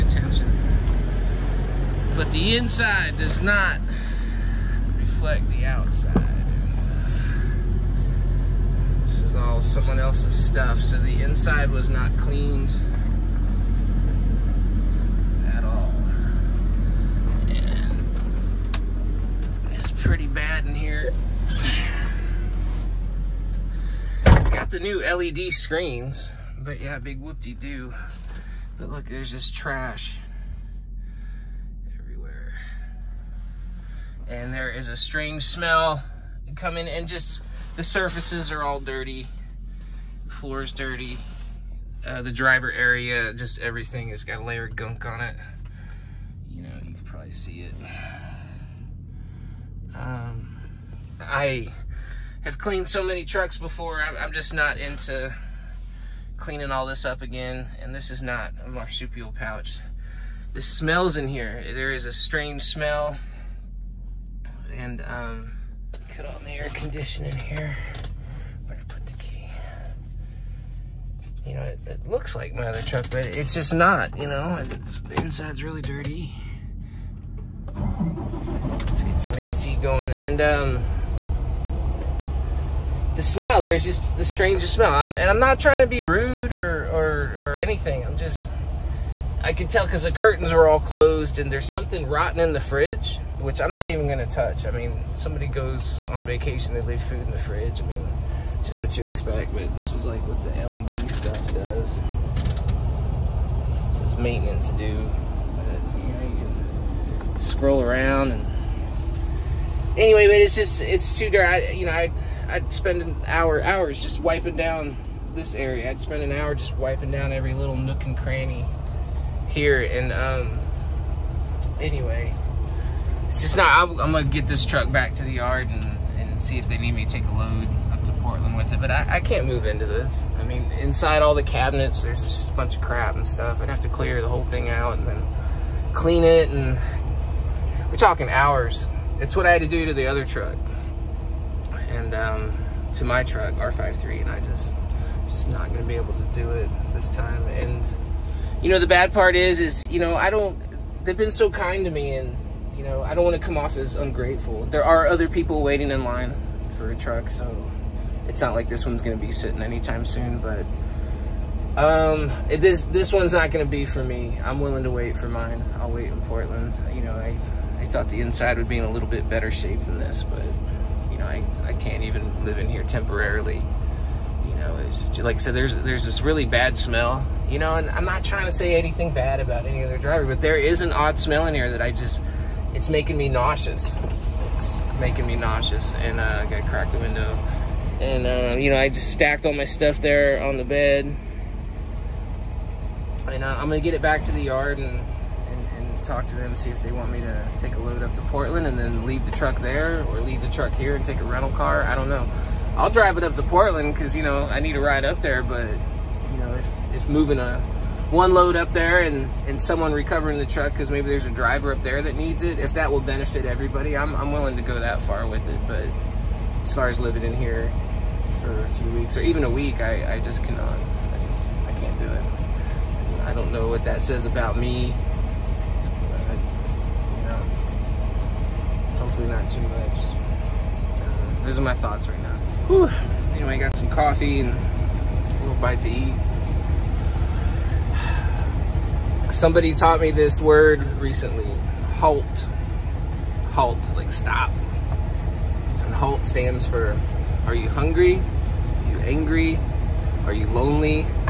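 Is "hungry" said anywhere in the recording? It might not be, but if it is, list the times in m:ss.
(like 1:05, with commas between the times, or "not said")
4:07.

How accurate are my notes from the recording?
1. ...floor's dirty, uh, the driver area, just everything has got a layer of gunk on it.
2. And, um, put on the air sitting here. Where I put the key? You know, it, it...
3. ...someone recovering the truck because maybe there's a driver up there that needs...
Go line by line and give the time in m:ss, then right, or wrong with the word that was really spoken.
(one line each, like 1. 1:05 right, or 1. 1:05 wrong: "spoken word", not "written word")
1. 0:40 right
2. 1:04 wrong: "conditioning", not "sitting"
3. 3:29 right.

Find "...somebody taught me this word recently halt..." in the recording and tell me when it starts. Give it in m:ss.
3:59.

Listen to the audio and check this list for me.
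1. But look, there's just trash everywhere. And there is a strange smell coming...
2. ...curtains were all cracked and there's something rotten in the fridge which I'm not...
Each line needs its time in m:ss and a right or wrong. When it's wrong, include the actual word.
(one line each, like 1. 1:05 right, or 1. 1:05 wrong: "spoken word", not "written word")
1. 0:28 right
2. 1:30 wrong: "closed", not "cracked".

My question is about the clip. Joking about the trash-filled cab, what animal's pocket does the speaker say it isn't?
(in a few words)
a marsupial pouch.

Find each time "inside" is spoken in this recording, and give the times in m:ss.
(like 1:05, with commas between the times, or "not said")
0:02, 0:11, 1:15, 2:10, 2:48.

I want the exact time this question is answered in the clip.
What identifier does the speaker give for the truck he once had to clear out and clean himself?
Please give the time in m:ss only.
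2:23.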